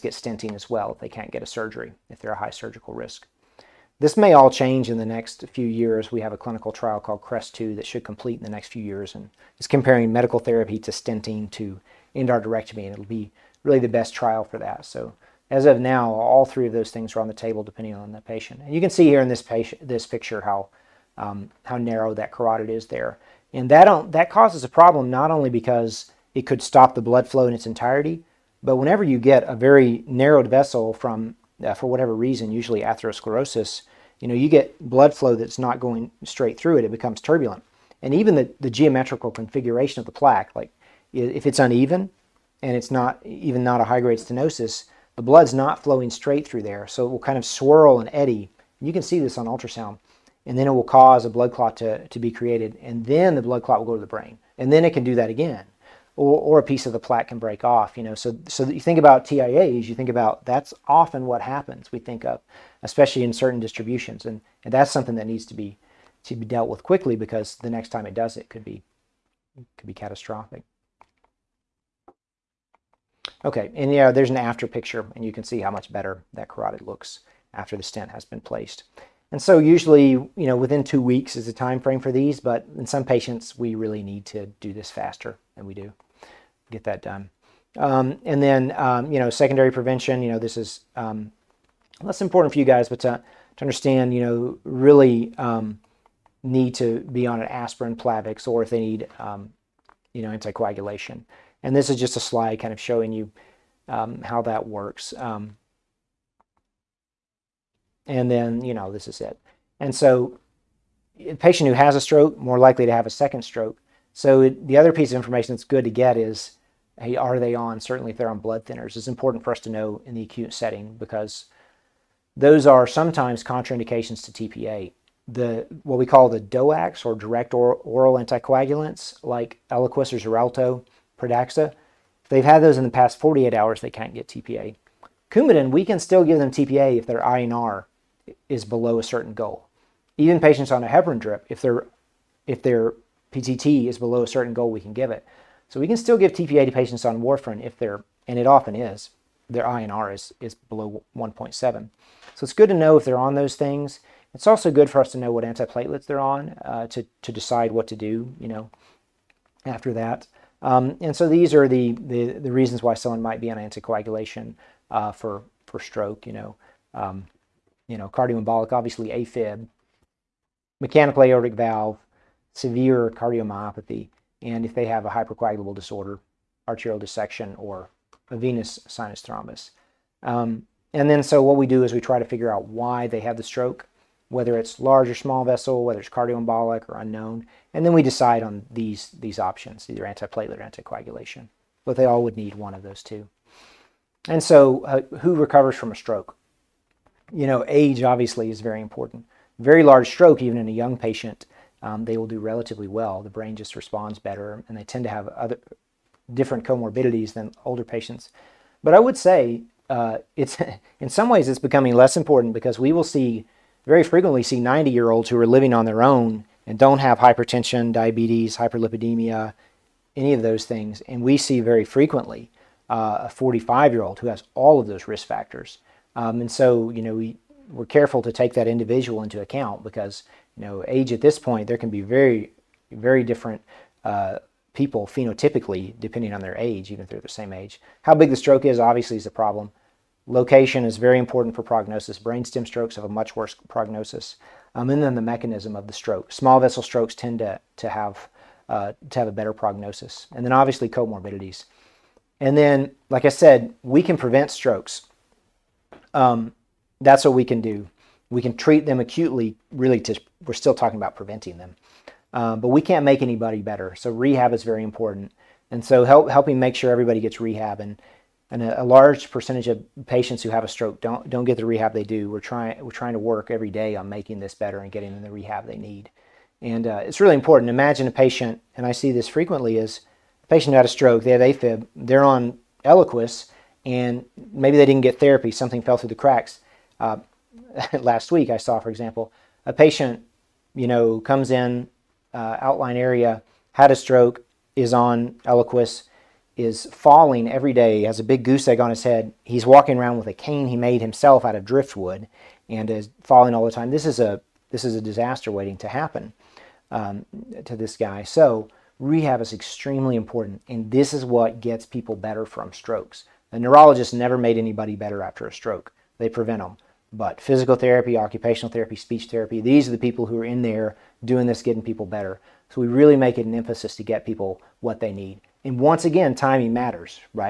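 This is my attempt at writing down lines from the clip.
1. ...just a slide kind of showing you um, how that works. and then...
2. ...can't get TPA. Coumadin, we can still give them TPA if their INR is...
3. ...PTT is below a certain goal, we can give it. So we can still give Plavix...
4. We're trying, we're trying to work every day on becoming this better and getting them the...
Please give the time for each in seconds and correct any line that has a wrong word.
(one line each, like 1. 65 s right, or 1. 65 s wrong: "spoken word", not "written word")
1. 101 s right
2. 133 s right
3. 143 s wrong: "TPA", not "Plavix"
4. 272 s wrong: "making", not "becoming".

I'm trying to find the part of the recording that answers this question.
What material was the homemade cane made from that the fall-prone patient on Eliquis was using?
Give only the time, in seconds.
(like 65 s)
301 s.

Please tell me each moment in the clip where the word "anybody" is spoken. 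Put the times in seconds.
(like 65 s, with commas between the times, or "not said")
263 s, 314 s.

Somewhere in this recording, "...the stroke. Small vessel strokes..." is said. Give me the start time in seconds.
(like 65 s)
245 s.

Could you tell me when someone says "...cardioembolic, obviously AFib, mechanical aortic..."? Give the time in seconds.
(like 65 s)
168 s.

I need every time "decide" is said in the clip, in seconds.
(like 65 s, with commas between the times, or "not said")
157 s, 188 s.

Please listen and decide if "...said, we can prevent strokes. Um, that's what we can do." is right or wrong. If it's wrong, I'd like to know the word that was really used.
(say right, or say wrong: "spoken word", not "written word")
right.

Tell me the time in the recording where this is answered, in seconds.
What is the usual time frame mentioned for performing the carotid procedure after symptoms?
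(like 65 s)
80 s.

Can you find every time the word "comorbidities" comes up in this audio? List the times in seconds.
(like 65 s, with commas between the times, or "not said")
206 s, 250 s.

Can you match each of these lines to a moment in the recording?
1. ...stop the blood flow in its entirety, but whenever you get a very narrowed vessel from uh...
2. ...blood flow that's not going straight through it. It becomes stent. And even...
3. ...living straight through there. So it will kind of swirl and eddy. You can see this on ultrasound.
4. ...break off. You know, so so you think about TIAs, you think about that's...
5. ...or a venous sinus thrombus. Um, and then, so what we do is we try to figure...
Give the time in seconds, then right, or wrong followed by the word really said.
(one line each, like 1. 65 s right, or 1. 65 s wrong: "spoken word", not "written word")
1. 26 s right
2. 34 s wrong: "turbulent", not "stent"
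3. 45 s wrong: "flowing", not "living"
4. 57 s right
5. 177 s right.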